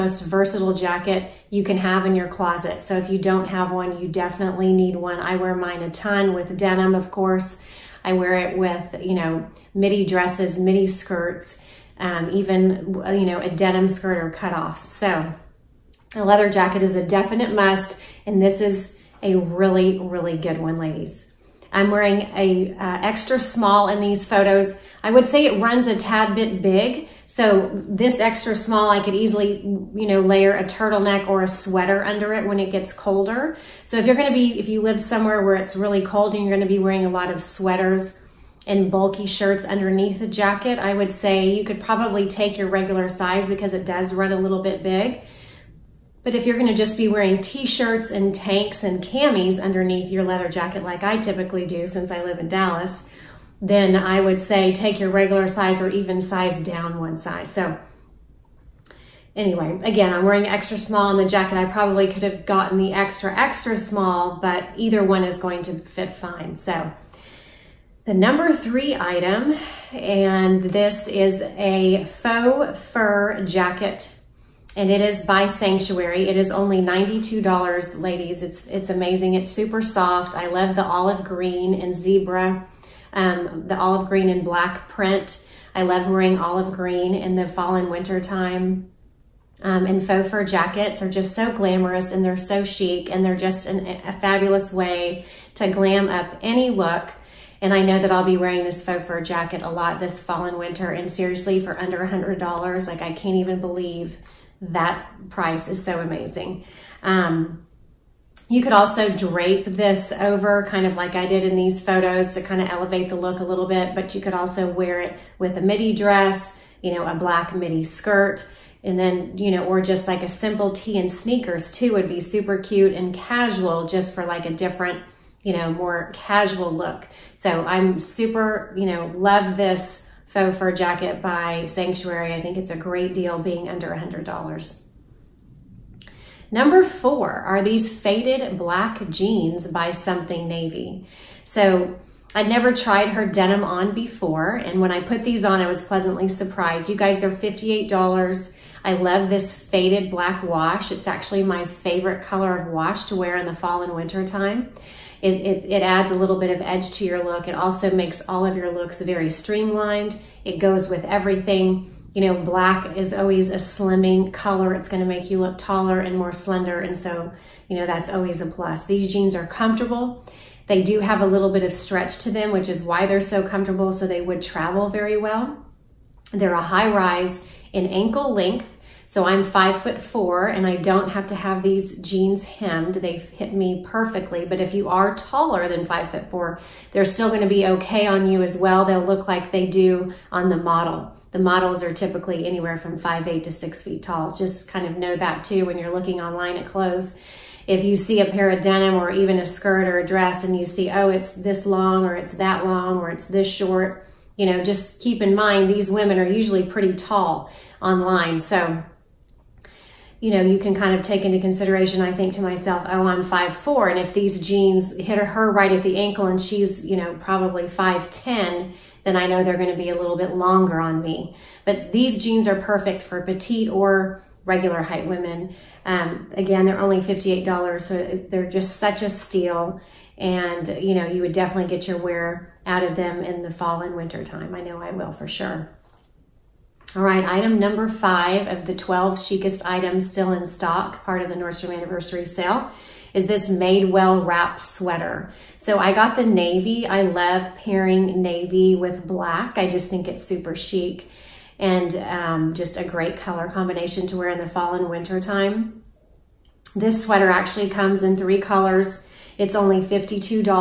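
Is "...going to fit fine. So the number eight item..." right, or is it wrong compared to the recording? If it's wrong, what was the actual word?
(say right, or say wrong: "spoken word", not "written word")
wrong: "three", not "eight".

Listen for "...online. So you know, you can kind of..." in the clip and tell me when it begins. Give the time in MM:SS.
03:27.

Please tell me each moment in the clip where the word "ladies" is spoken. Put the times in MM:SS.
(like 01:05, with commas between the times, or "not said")
00:20, 01:17.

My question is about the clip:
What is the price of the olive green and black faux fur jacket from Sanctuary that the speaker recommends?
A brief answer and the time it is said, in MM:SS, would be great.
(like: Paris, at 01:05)
$92, at 01:16.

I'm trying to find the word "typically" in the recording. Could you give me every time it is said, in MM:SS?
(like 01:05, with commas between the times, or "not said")
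00:51, 03:11.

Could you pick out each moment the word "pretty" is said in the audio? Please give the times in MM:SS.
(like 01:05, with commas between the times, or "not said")
03:26.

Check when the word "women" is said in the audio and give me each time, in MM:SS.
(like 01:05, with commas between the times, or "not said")
03:25, 03:45.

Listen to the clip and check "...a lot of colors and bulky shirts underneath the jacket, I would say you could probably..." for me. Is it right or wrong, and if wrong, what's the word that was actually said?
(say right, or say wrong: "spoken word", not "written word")
wrong: "sweaters", not "colors".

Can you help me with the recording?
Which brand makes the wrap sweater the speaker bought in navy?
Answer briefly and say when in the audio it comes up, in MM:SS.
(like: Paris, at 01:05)
Madewell, at 04:03.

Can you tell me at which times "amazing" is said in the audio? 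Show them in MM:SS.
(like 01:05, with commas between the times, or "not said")
01:18, 01:45.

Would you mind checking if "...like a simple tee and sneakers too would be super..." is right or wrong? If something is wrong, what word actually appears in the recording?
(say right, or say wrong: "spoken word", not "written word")
right.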